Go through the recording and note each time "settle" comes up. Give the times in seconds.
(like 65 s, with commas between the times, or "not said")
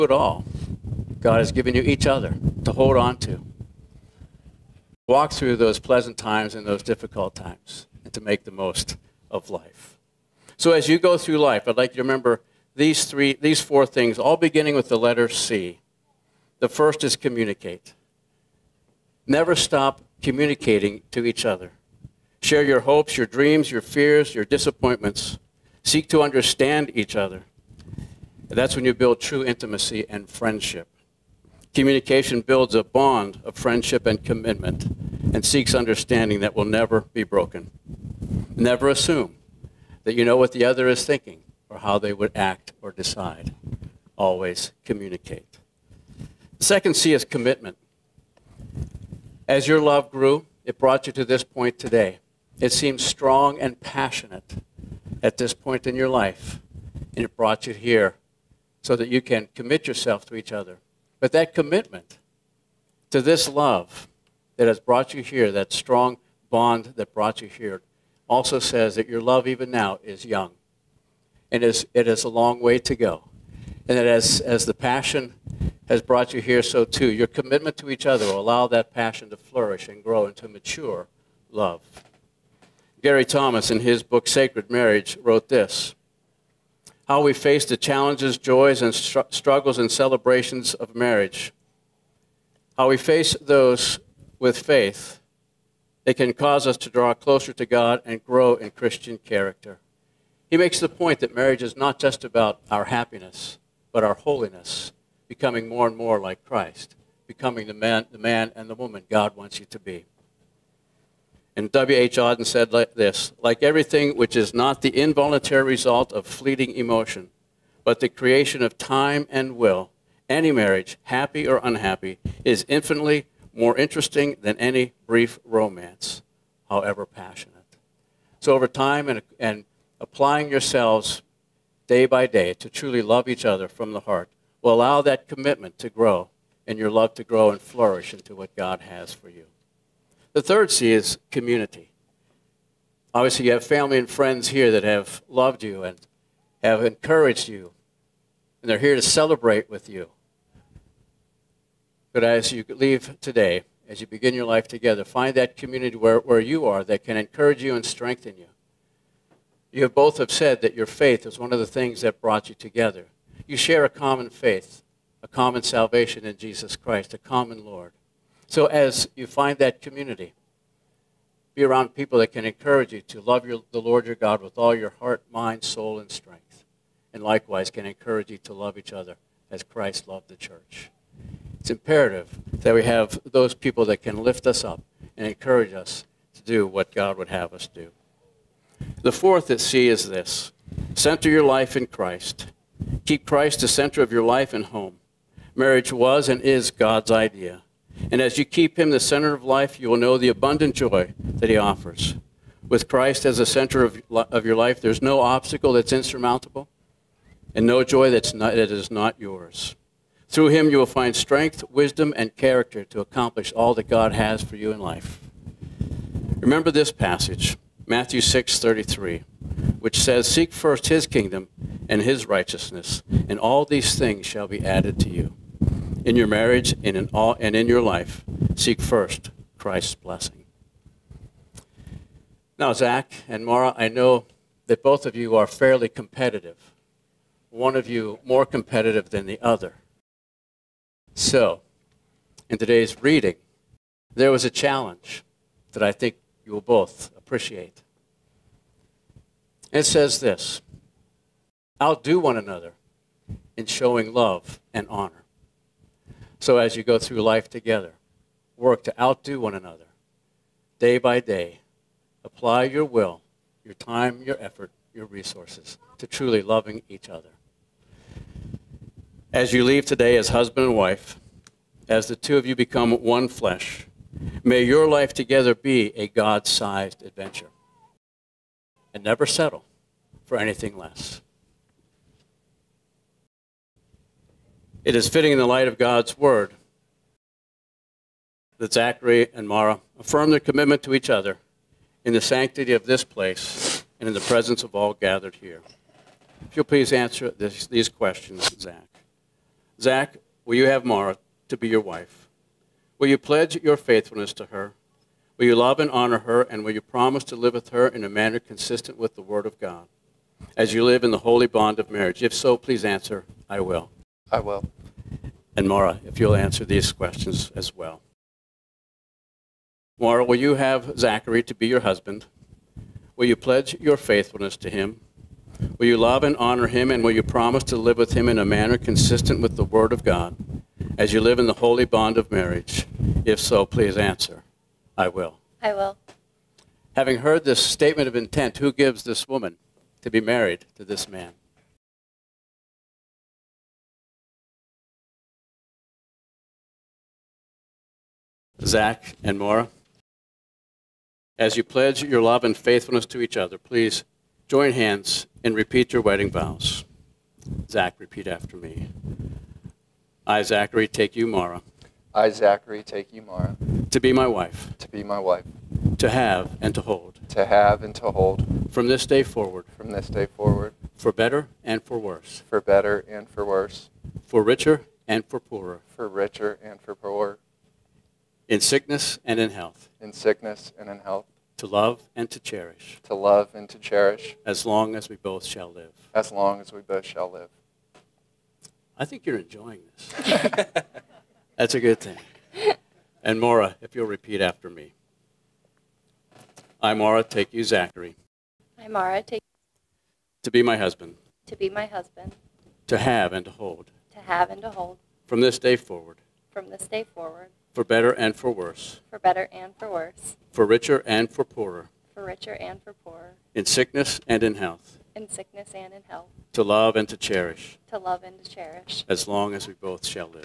279 s.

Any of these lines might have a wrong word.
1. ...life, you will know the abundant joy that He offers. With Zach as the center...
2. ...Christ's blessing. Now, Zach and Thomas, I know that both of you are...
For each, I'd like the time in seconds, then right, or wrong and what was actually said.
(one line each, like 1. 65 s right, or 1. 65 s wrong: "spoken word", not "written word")
1. 199 s wrong: "Christ", not "Zach"
2. 229 s wrong: "Maura", not "Thomas".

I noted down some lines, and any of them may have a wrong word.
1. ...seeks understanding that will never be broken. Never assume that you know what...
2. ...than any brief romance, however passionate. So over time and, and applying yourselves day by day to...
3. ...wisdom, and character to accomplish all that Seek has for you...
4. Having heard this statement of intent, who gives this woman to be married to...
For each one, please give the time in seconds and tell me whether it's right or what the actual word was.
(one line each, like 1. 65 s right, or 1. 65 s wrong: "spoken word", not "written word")
1. 35 s right
2. 124 s right
3. 211 s wrong: "God", not "Seek"
4. 336 s right.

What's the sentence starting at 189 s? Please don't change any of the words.
The fourth that sea is this center your life in Christ.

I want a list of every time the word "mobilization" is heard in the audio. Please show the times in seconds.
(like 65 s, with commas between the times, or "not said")
not said.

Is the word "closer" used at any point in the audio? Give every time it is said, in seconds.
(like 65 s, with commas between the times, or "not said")
97 s.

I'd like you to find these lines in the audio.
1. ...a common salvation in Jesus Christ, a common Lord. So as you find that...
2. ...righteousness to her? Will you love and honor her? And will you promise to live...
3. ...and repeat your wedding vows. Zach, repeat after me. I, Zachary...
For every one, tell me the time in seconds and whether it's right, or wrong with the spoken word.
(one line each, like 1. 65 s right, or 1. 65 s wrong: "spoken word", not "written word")
1. 165 s right
2. 303 s wrong: "faithfulness", not "righteousness"
3. 355 s right.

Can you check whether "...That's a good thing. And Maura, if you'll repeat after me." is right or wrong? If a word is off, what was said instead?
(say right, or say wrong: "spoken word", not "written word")
right.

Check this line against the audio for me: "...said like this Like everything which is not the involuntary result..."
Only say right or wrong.
right.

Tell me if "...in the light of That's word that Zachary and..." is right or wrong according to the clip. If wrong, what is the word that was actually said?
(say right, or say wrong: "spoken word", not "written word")
wrong: "God", not "That".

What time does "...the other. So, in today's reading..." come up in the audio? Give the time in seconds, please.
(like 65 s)
239 s.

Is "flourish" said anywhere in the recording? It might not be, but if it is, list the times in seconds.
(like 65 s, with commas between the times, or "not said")
79 s, 137 s.